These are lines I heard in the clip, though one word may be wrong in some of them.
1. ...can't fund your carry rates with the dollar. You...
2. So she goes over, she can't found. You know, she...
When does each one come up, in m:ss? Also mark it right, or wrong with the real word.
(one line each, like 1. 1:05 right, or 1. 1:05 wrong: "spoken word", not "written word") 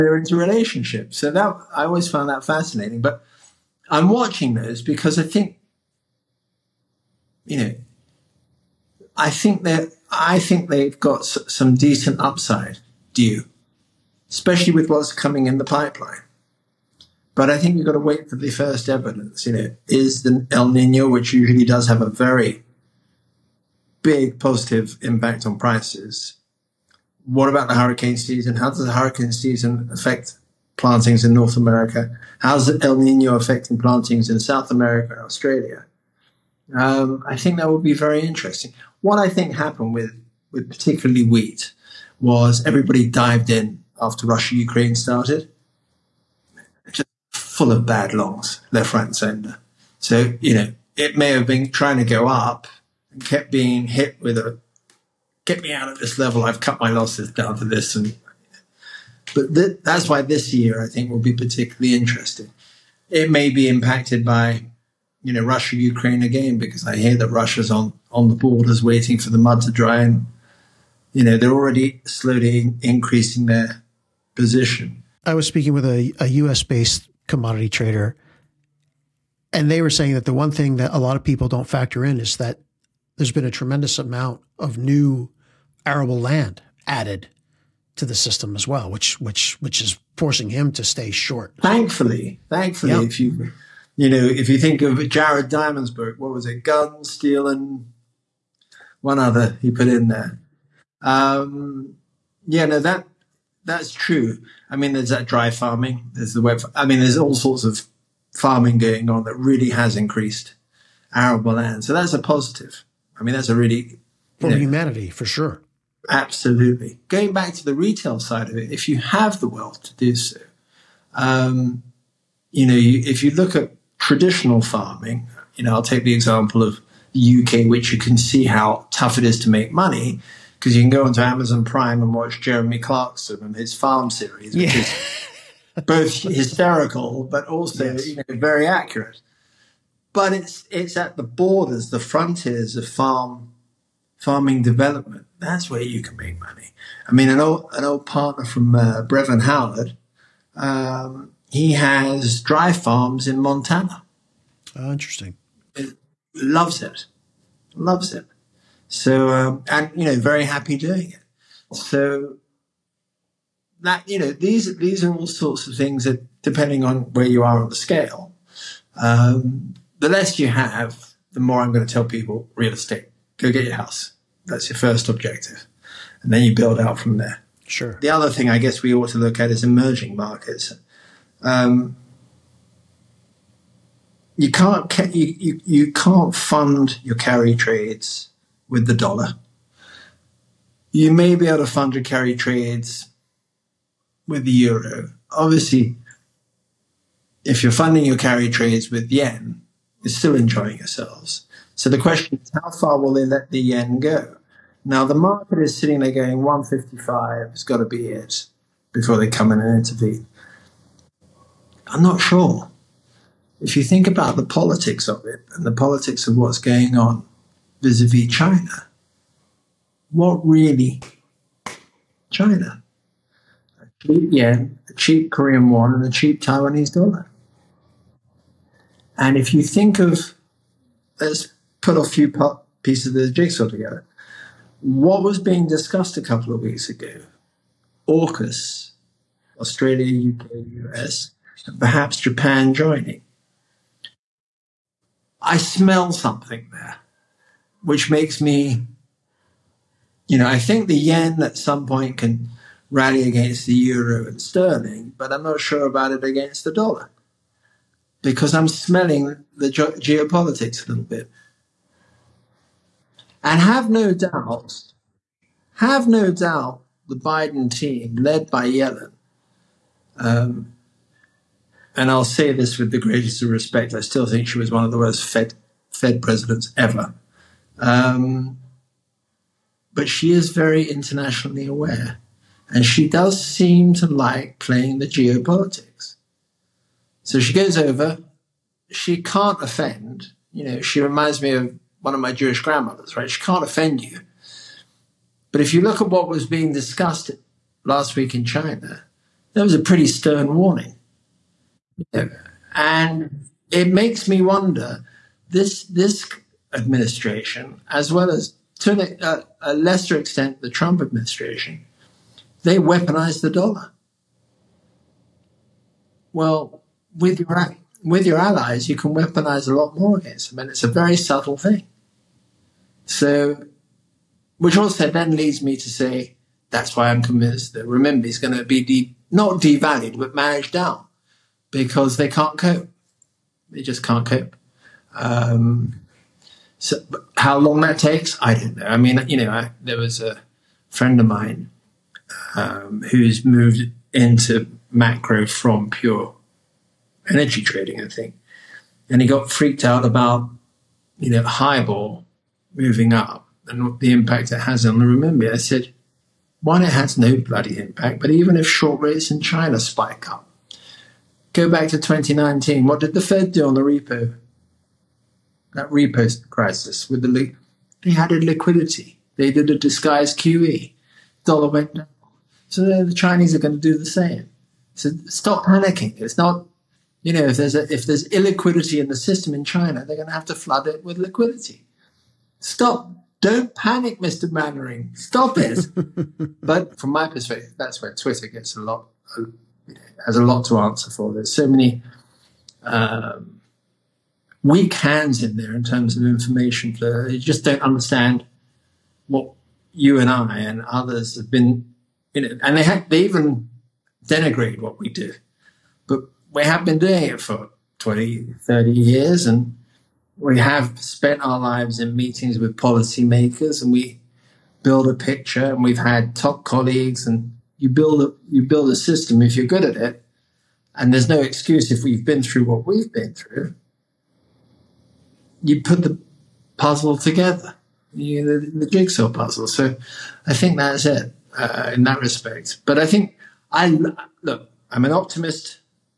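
1. 3:05 wrong: "trades", not "rates"
2. 4:47 wrong: "offend", not "found".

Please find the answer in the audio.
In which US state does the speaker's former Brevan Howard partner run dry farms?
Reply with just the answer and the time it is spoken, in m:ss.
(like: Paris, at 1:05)
Montana, at 2:33.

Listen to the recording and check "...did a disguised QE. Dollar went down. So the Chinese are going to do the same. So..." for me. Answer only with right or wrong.
right.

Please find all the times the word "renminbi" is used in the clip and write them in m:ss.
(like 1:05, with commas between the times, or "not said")
5:27, 5:55.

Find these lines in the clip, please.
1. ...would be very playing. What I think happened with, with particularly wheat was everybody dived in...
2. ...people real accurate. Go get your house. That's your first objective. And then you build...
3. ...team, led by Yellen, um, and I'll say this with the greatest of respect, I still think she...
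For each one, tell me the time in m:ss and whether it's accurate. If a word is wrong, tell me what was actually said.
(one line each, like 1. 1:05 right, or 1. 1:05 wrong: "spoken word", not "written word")
1. 0:37 wrong: "interesting", not "playing"
2. 2:52 wrong: "estate", not "accurate"
3. 4:27 right.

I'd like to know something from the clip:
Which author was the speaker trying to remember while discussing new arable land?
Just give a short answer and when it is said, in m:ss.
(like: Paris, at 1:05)
Jared Diamond, at 1:35.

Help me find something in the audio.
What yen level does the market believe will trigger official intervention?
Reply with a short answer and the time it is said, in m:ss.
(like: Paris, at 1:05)
155, at 3:26.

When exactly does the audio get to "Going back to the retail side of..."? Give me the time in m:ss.
1:57.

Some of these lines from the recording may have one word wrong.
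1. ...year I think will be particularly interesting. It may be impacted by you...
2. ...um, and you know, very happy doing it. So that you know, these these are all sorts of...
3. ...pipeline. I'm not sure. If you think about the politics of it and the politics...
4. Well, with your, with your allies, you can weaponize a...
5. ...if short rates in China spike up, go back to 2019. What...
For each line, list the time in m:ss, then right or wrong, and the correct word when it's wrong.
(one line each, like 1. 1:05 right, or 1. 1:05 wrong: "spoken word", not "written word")
1. 1:00 right
2. 2:39 right
3. 3:29 wrong: "intervene", not "pipeline"
4. 5:16 right
5. 5:58 right.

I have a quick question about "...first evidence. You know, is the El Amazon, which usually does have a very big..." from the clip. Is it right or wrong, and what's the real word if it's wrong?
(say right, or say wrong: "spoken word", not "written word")
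wrong: "Nino", not "Amazon".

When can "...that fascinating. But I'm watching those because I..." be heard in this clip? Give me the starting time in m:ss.
0:02.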